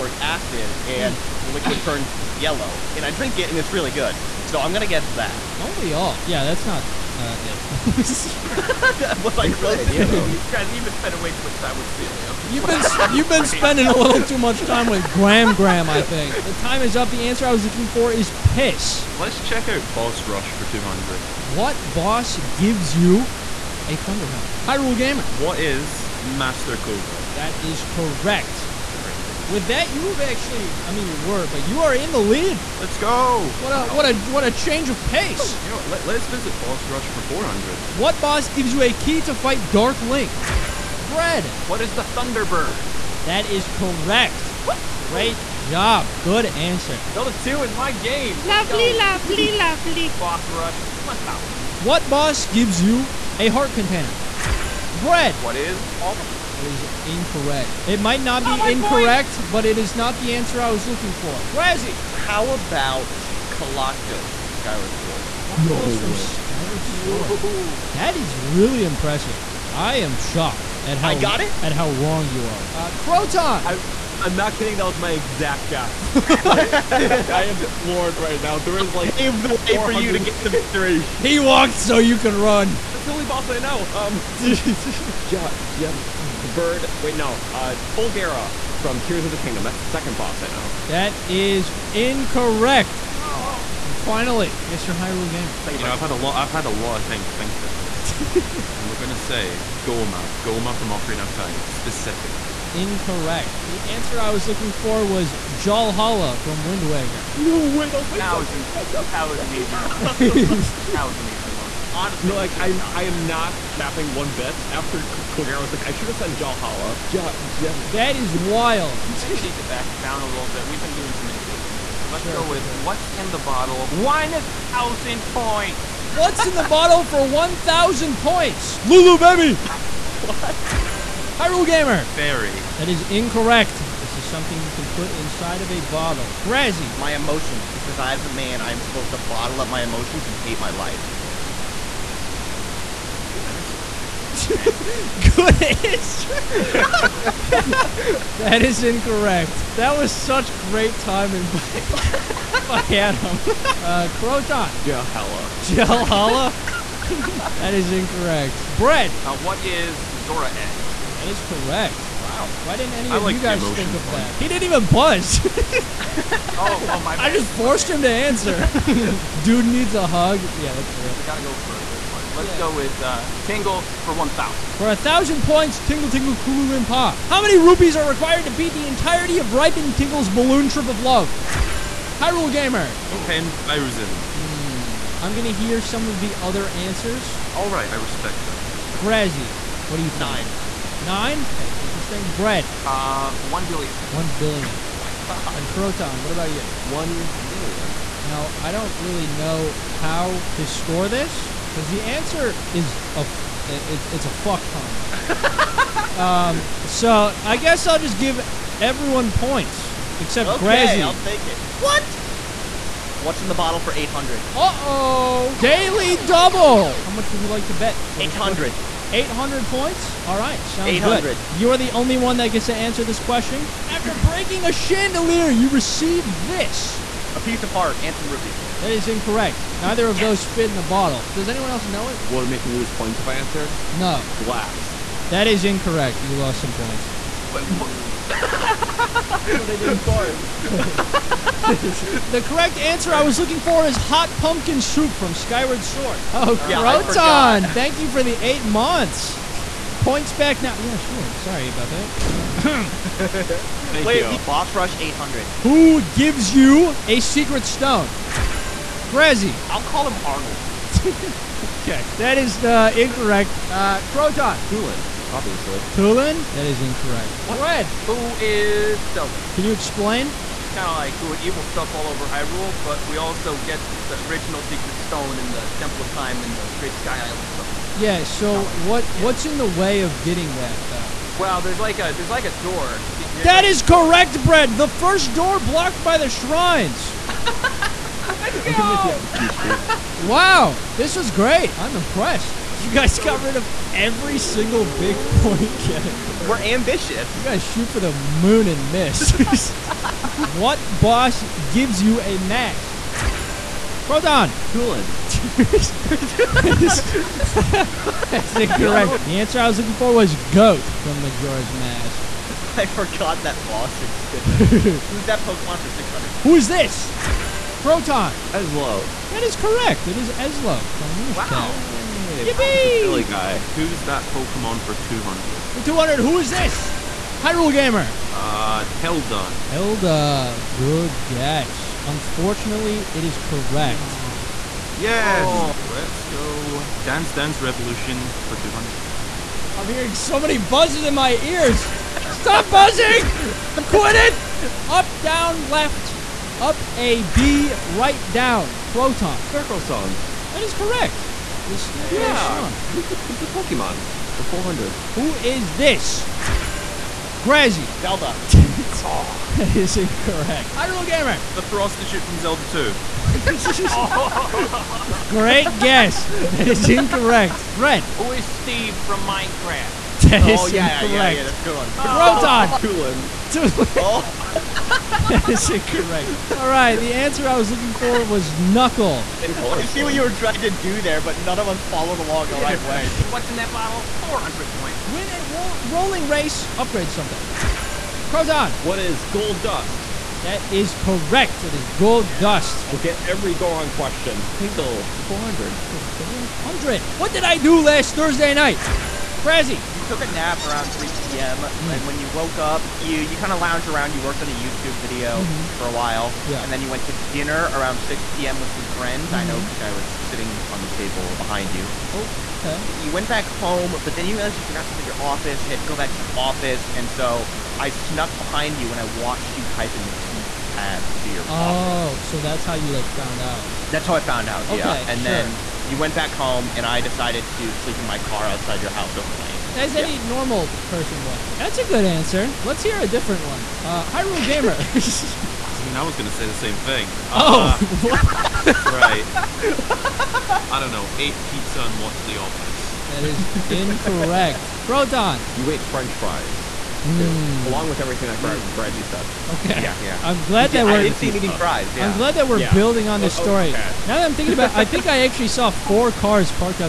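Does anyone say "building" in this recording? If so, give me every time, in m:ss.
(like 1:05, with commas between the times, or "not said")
7:32.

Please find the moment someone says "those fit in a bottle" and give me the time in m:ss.
3:50.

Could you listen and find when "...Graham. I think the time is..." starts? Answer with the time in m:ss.
0:15.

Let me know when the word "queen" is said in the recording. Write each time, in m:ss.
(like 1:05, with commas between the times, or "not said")
not said.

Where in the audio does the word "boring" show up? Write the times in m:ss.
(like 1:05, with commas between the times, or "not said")
not said.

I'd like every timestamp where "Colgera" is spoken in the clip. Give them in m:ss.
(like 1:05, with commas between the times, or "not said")
1:27, 1:55.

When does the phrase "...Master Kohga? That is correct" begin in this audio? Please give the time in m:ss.
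0:26.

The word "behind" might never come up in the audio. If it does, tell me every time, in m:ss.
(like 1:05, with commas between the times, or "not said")
6:51, 6:58.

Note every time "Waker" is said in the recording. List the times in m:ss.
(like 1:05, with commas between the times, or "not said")
1:46.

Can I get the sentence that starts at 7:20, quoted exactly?
I don't know, ate pizza and watched The Office.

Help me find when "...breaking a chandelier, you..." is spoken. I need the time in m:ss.
3:44.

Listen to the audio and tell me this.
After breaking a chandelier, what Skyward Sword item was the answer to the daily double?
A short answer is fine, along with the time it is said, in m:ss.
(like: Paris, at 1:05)
Hot pumpkin soup, at 4:03.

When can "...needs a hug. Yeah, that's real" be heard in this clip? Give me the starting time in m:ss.
2:49.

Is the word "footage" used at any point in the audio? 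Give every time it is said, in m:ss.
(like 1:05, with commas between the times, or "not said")
not said.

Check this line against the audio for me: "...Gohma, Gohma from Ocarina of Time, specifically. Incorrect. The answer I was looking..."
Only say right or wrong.
right.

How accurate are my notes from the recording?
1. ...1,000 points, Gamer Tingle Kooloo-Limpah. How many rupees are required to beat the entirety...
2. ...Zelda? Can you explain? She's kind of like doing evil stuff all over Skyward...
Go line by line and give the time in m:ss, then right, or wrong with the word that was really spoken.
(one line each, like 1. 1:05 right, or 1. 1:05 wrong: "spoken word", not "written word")
1. 2:54 wrong: "Tingle", not "Gamer"
2. 4:29 wrong: "Hyrule", not "Skyward".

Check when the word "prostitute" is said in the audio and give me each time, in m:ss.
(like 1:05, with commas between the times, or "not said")
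6:01.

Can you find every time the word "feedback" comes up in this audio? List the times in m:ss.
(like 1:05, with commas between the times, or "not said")
not said.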